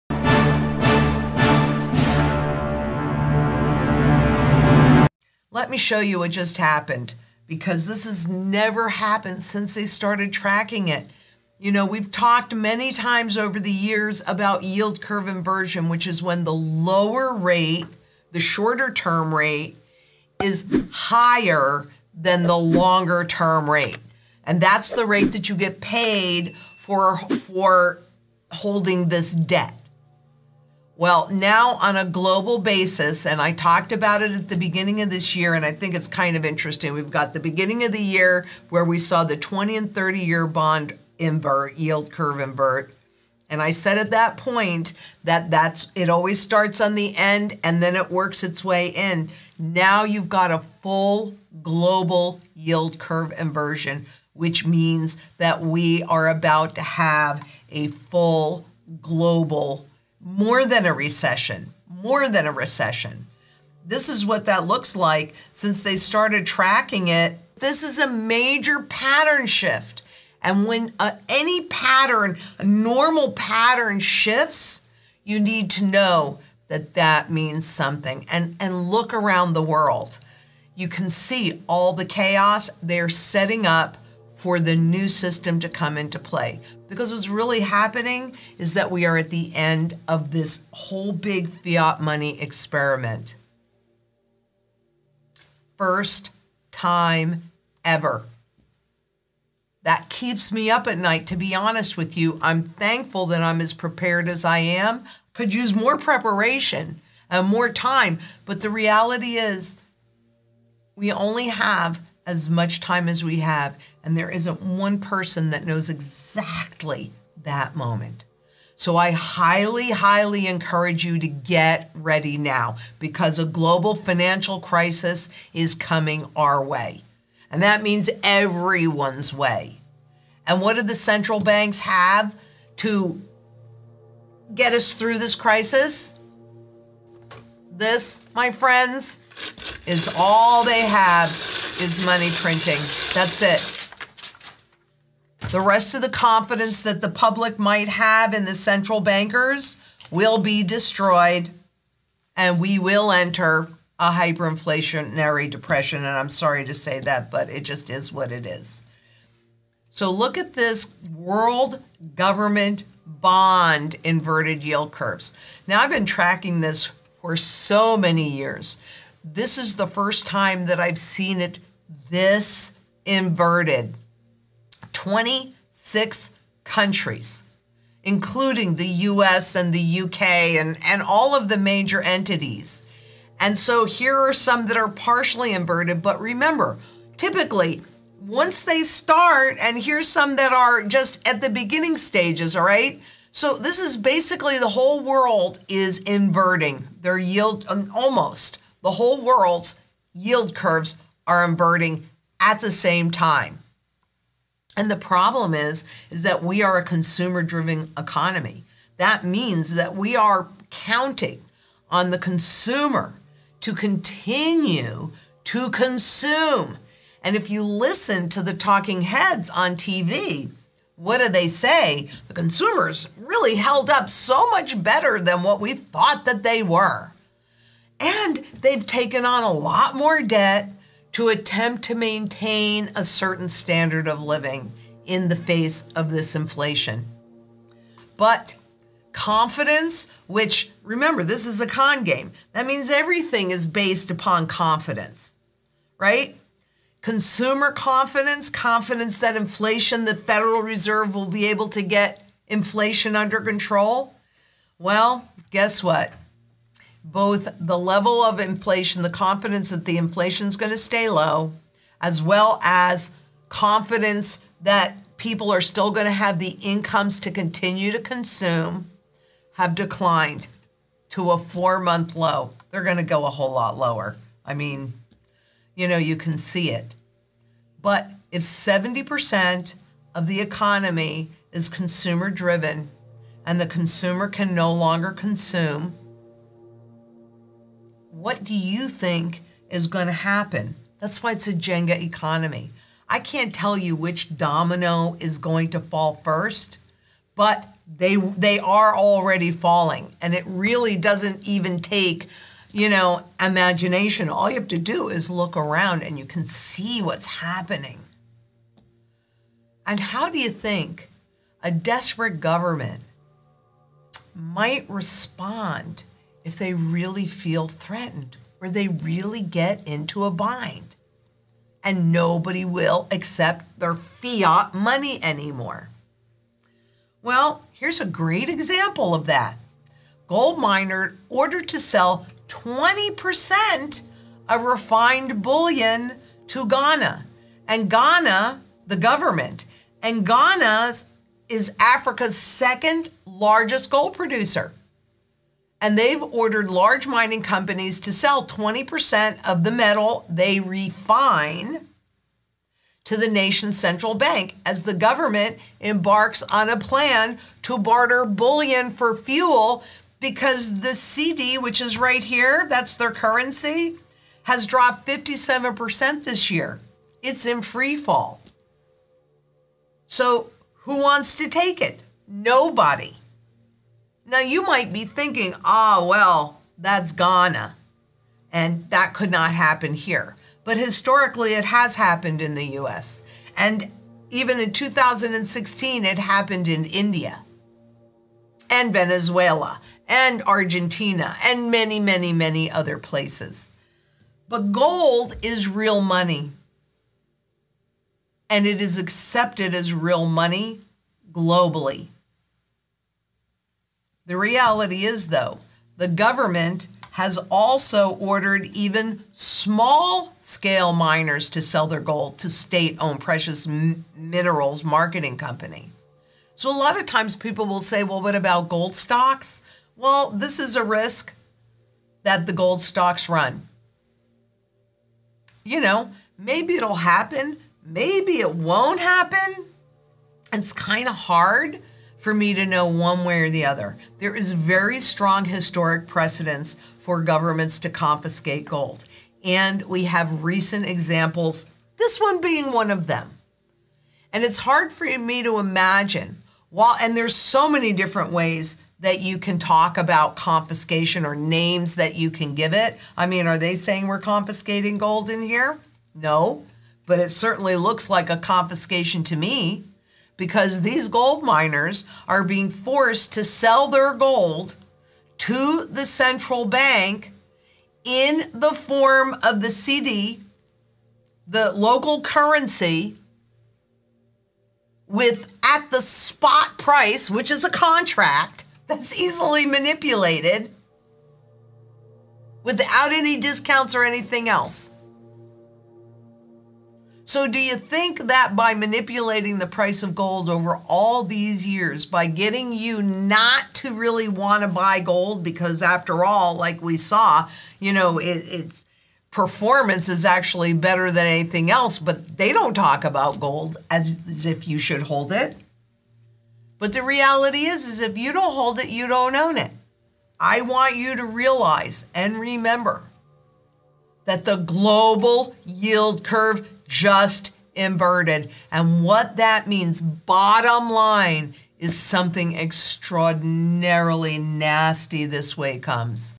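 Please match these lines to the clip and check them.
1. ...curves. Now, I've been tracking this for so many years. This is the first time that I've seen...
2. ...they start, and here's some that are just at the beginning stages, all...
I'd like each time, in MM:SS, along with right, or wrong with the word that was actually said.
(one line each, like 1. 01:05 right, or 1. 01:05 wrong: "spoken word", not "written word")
1. 02:44 right
2. 03:08 right.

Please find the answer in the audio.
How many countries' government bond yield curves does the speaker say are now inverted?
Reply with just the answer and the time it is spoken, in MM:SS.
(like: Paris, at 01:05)
26, at 02:54.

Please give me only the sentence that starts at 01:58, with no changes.
So I highly, highly encourage you to get ready now because a global financial crisis is coming our way.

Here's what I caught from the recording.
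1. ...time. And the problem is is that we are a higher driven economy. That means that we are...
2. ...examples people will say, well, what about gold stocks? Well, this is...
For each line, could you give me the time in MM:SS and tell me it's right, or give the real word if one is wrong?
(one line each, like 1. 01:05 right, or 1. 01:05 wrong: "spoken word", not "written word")
1. 03:23 wrong: "consumer", not "higher"
2. 06:57 wrong: "times", not "examples".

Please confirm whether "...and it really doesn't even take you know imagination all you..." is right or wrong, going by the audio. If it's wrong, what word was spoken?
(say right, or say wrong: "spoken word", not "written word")
right.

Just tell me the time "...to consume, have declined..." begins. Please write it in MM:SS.
04:27.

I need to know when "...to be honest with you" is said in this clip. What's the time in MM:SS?
01:41.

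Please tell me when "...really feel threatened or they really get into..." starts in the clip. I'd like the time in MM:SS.
05:16.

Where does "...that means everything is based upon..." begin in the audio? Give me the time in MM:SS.
04:02.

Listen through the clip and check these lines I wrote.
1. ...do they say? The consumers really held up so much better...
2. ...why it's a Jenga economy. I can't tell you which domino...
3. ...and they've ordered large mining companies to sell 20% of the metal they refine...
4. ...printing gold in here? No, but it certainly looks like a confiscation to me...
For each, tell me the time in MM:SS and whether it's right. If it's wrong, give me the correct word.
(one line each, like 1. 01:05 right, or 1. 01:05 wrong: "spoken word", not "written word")
1. 03:41 right
2. 04:51 right
3. 05:45 right
4. 07:34 wrong: "confiscating", not "printing".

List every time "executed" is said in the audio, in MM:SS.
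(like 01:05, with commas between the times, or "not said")
not said.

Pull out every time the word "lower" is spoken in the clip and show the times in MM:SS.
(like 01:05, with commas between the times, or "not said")
00:16, 04:33.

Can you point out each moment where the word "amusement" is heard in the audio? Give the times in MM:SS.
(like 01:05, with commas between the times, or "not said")
not said.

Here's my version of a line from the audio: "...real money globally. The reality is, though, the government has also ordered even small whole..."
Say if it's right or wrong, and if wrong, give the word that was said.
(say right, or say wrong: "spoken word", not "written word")
wrong: "scale", not "whole".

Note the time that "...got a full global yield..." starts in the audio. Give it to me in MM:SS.
00:50.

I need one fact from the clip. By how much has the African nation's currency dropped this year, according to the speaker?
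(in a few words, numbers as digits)
57%.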